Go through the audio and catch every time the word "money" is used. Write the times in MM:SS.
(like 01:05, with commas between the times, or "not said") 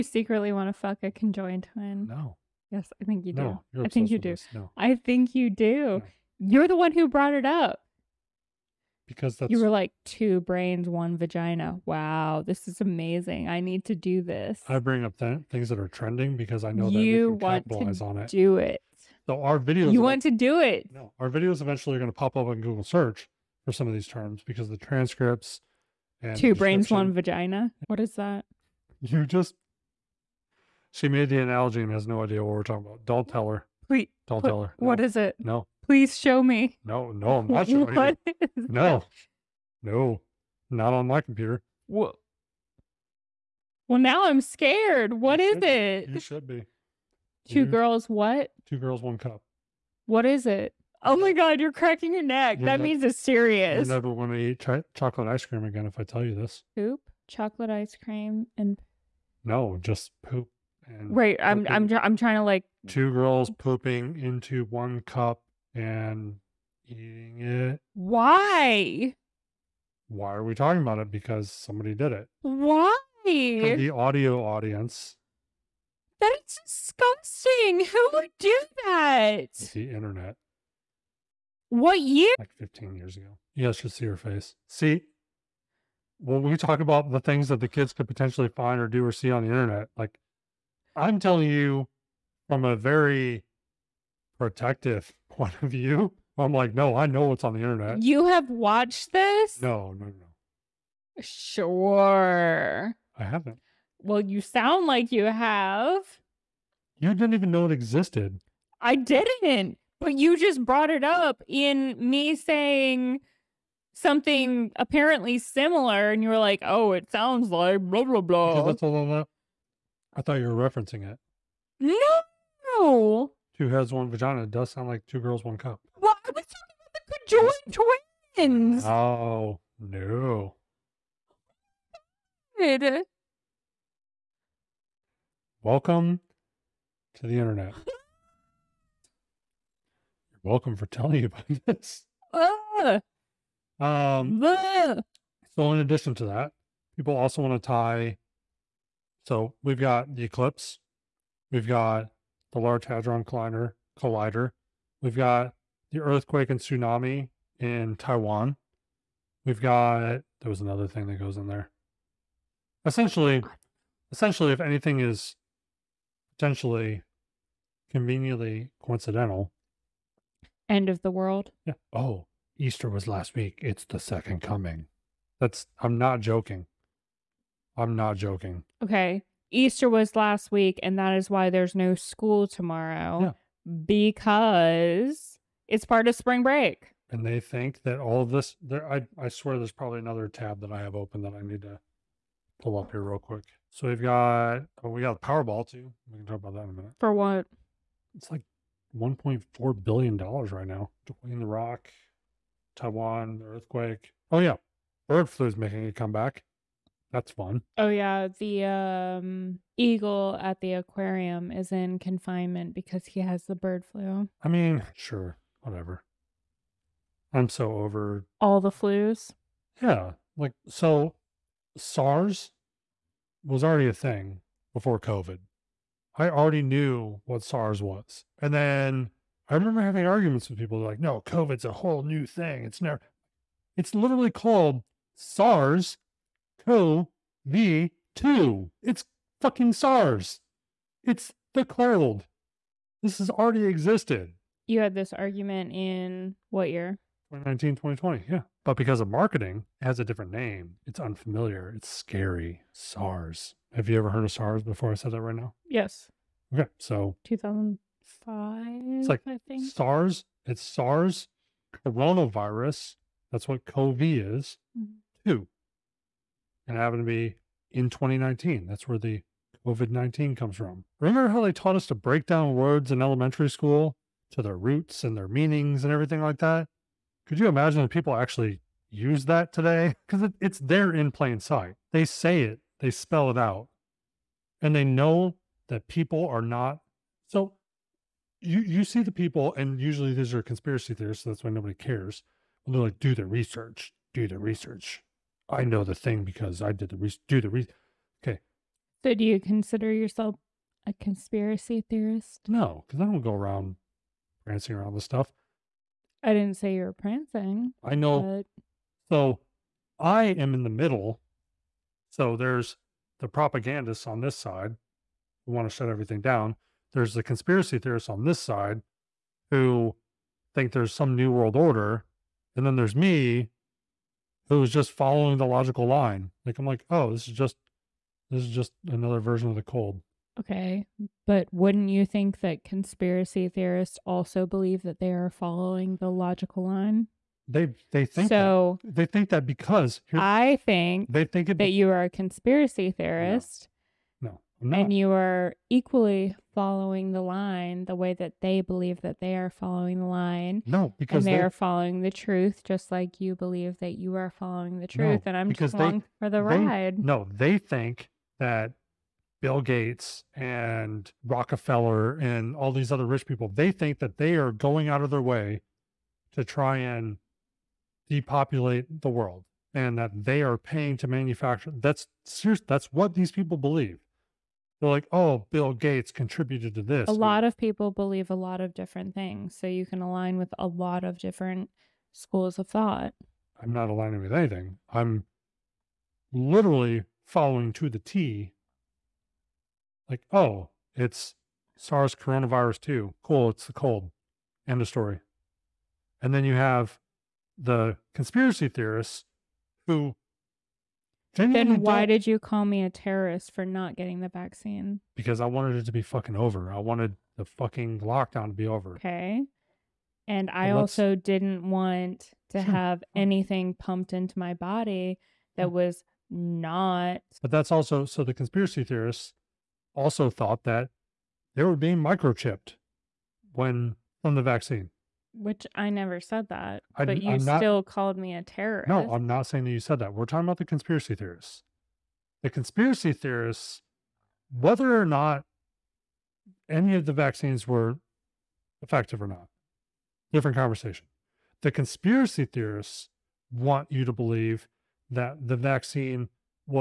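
not said.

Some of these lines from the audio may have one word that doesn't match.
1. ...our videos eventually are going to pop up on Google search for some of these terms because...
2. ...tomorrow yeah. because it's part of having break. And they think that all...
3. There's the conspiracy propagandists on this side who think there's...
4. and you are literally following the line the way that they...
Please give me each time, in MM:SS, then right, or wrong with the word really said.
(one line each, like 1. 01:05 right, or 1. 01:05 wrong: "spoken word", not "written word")
1. 00:21 right
2. 03:02 wrong: "spring", not "having"
3. 05:16 wrong: "theorists", not "propagandists"
4. 05:44 wrong: "equally", not "literally".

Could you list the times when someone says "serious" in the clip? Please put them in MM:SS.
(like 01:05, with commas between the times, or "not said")
00:53, 06:12.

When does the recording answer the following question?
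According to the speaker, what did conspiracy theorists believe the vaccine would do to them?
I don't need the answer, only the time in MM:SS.
07:01.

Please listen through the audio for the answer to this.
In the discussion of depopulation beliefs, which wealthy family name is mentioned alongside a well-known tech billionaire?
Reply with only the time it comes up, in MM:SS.
06:01.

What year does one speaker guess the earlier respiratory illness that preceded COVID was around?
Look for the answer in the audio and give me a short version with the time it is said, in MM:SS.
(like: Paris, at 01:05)
2005, at 04:17.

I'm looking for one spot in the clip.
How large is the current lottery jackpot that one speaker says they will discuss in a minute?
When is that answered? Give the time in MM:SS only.
03:18.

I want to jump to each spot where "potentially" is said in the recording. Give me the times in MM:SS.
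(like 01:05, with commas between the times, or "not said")
01:28, 02:46.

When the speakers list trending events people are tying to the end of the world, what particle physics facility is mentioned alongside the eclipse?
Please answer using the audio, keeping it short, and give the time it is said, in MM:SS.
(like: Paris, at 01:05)
Large Hadron Collider, at 02:32.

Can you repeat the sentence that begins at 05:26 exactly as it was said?
Like I'm like, oh, this is just this is just another version of the cold.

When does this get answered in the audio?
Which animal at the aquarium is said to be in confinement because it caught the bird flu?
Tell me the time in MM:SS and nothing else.
03:29.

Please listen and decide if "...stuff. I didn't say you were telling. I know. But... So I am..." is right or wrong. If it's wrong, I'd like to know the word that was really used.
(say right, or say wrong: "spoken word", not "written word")
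wrong: "prancing", not "telling".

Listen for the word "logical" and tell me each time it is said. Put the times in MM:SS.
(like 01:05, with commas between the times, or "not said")
05:25, 05:36.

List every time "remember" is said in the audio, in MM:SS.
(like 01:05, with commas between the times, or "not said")
03:49, 04:30.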